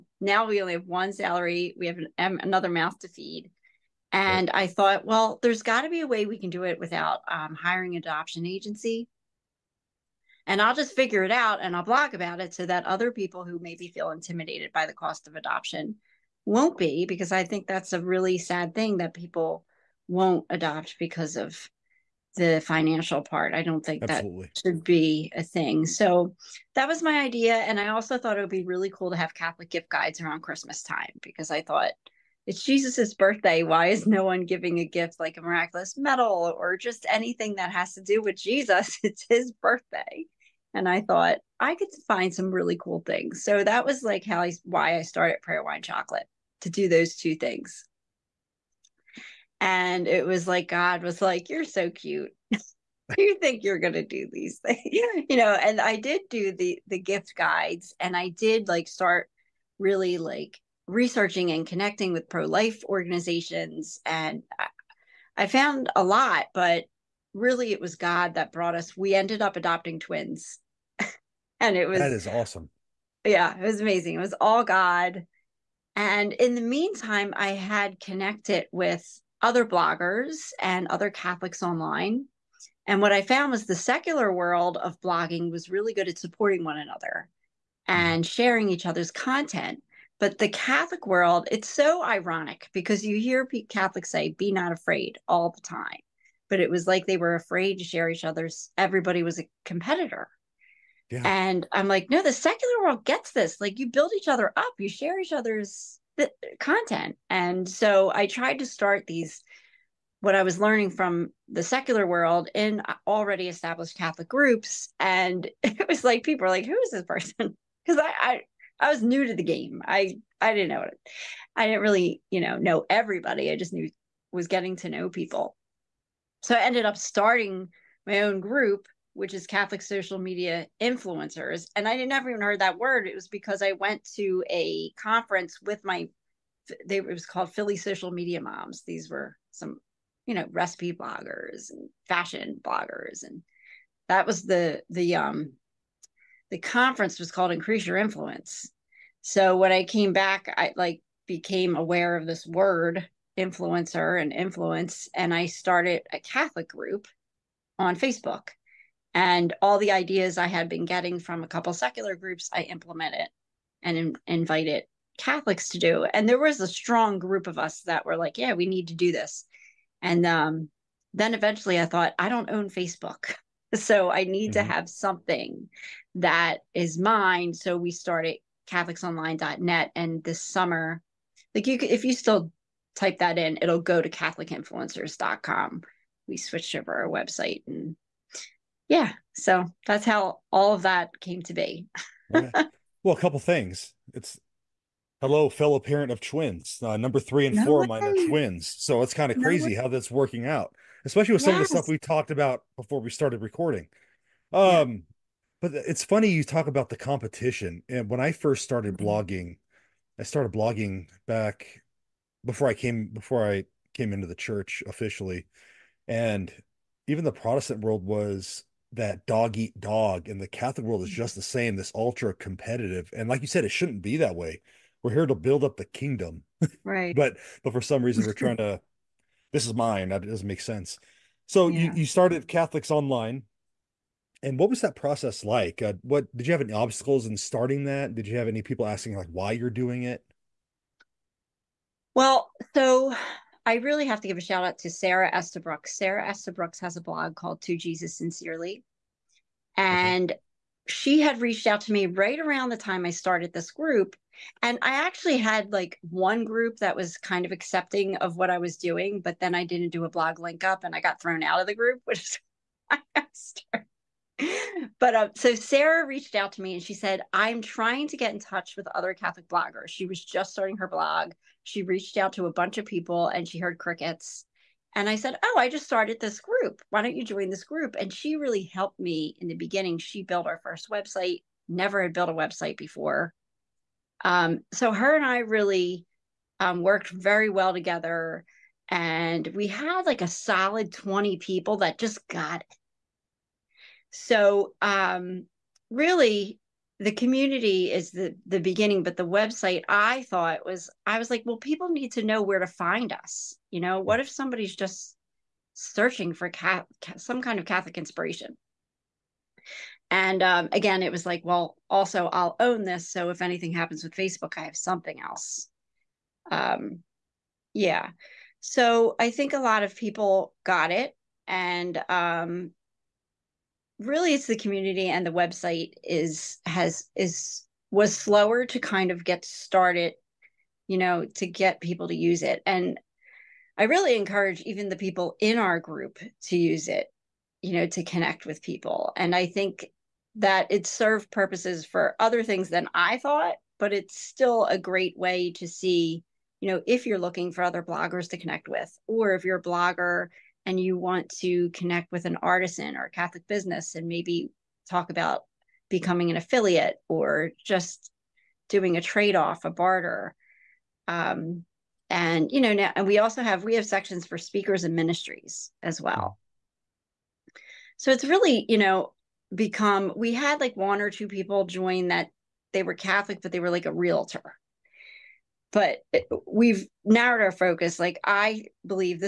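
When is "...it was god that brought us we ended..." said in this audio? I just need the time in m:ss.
1:07.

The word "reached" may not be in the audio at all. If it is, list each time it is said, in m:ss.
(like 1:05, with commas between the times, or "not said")
4:11, 4:26, 4:31.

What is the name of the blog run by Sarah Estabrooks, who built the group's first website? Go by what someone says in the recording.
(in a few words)
To Jesus Sincerely.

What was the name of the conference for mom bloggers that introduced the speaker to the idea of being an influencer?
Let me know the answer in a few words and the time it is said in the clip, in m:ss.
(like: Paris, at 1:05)
Increase Your Influence, at 2:27.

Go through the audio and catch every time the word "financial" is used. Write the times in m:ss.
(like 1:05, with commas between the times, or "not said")
0:22.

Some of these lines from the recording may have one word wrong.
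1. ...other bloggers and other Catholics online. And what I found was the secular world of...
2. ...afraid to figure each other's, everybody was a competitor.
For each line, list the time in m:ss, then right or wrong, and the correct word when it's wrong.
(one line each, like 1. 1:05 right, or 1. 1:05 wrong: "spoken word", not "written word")
1. 1:19 right
2. 1:37 wrong: "share", not "figure".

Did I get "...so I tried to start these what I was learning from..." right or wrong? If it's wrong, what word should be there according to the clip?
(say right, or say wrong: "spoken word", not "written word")
right.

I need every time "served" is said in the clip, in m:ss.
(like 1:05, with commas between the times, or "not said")
5:40.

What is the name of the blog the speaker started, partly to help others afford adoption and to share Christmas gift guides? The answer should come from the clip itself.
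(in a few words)
Prayer Wine Chocolate.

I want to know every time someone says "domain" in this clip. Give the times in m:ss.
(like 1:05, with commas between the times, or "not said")
not said.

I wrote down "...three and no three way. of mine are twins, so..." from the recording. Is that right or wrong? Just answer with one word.
wrong.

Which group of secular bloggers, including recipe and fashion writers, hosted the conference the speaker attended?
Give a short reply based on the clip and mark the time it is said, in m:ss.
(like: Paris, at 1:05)
Philly Social Media Moms, at 2:17.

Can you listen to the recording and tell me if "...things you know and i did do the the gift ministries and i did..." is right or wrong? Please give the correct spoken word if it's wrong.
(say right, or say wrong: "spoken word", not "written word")
wrong: "guides", not "ministries".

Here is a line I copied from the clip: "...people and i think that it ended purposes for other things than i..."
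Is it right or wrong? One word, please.
wrong.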